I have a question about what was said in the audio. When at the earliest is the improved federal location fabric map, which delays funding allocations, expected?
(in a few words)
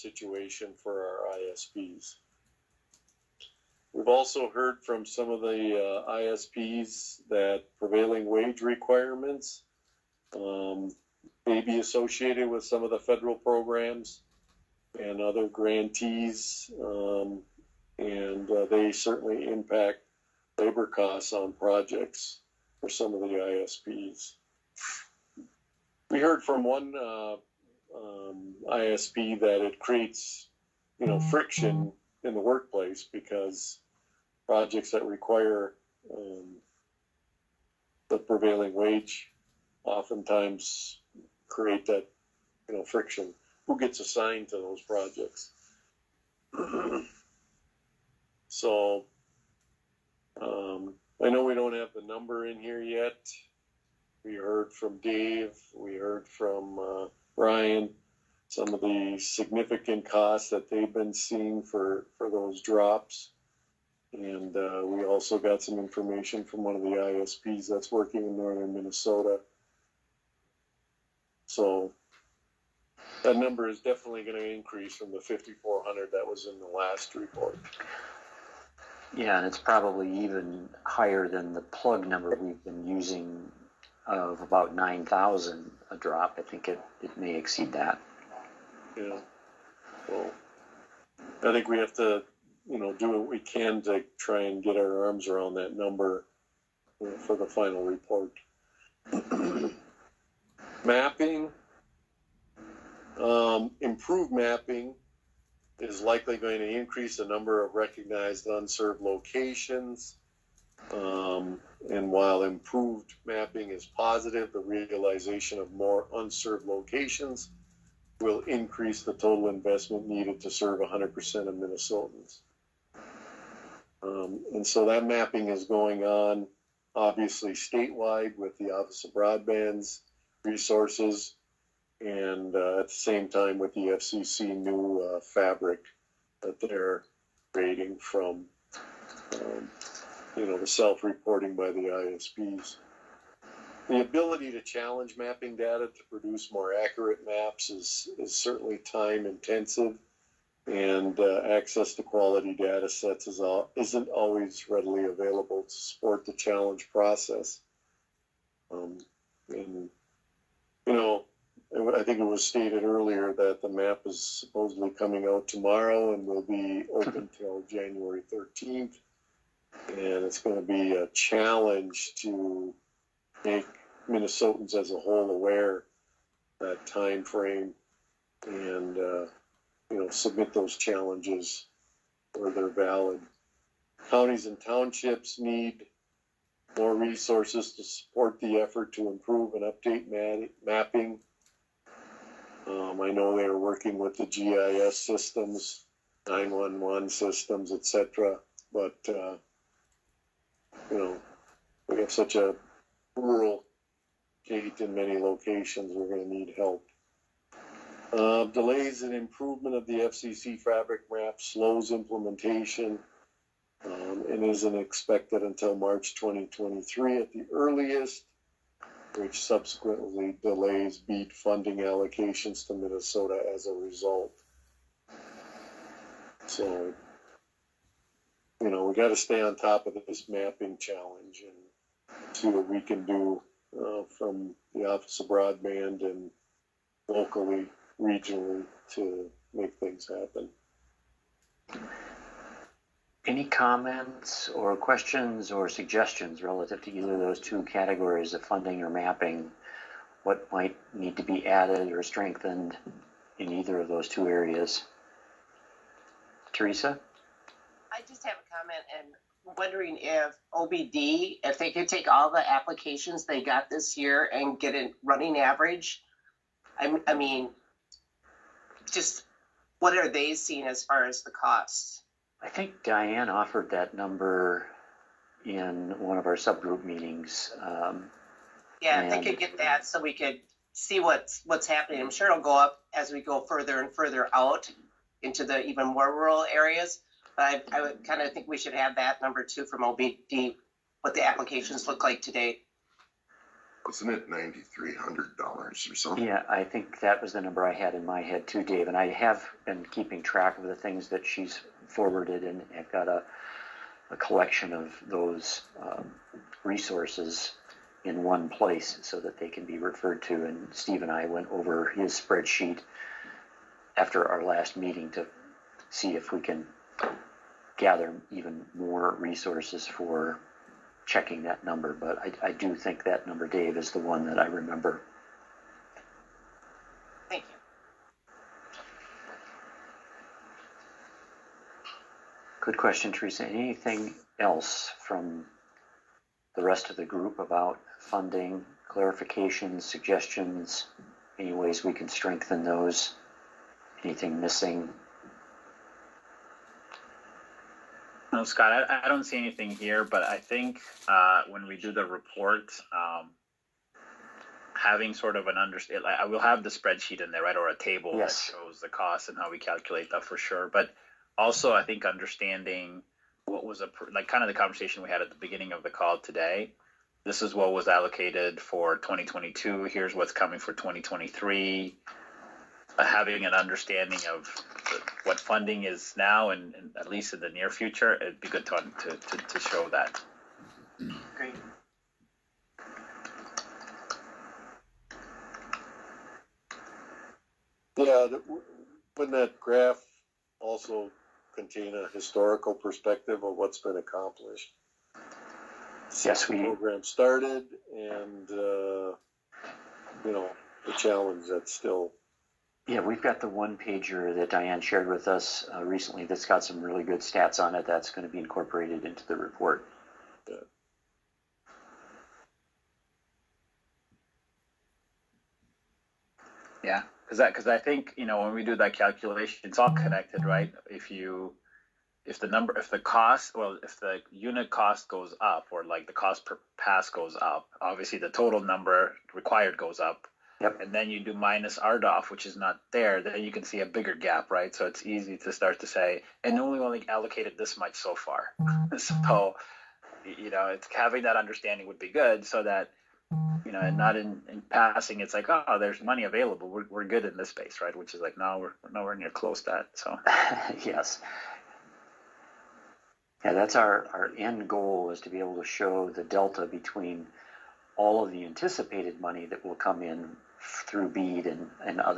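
March 2023.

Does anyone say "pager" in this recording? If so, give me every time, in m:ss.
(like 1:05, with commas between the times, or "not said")
6:43.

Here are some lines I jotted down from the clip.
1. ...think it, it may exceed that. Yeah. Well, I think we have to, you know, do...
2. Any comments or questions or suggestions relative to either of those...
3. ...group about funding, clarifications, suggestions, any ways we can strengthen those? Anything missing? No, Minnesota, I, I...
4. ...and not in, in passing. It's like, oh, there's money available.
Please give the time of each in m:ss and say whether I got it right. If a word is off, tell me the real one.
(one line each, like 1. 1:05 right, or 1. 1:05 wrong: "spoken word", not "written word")
1. 1:26 right
2. 4:03 right
3. 5:37 wrong: "Scott", not "Minnesota"
4. 7:23 right.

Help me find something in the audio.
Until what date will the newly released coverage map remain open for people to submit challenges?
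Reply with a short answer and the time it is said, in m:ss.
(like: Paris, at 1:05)
January 13th, at 2:47.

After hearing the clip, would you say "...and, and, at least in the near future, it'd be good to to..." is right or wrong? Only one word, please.
right.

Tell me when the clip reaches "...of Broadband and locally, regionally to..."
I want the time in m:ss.
3:55.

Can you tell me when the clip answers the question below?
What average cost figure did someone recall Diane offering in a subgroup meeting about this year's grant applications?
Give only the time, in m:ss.
4:54.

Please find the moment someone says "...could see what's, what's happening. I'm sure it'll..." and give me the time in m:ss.
4:40.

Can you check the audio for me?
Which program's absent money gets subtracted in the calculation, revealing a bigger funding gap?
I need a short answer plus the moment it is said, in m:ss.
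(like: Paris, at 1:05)
RDOF, at 7:11.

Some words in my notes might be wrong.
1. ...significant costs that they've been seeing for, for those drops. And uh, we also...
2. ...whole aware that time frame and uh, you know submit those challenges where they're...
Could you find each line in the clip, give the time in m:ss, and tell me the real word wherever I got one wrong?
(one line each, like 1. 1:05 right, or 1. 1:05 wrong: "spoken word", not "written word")
1. 0:59 right
2. 2:54 right.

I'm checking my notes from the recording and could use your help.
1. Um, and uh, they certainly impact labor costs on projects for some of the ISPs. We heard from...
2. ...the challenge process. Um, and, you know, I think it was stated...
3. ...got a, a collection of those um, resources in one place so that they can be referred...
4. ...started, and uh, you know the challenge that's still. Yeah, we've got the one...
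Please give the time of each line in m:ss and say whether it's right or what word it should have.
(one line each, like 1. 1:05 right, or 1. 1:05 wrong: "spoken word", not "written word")
1. 0:16 right
2. 2:36 right
3. 5:02 right
4. 6:37 right.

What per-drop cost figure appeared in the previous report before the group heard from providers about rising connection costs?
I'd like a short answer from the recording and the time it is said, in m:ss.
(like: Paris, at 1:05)
5,400, at 1:15.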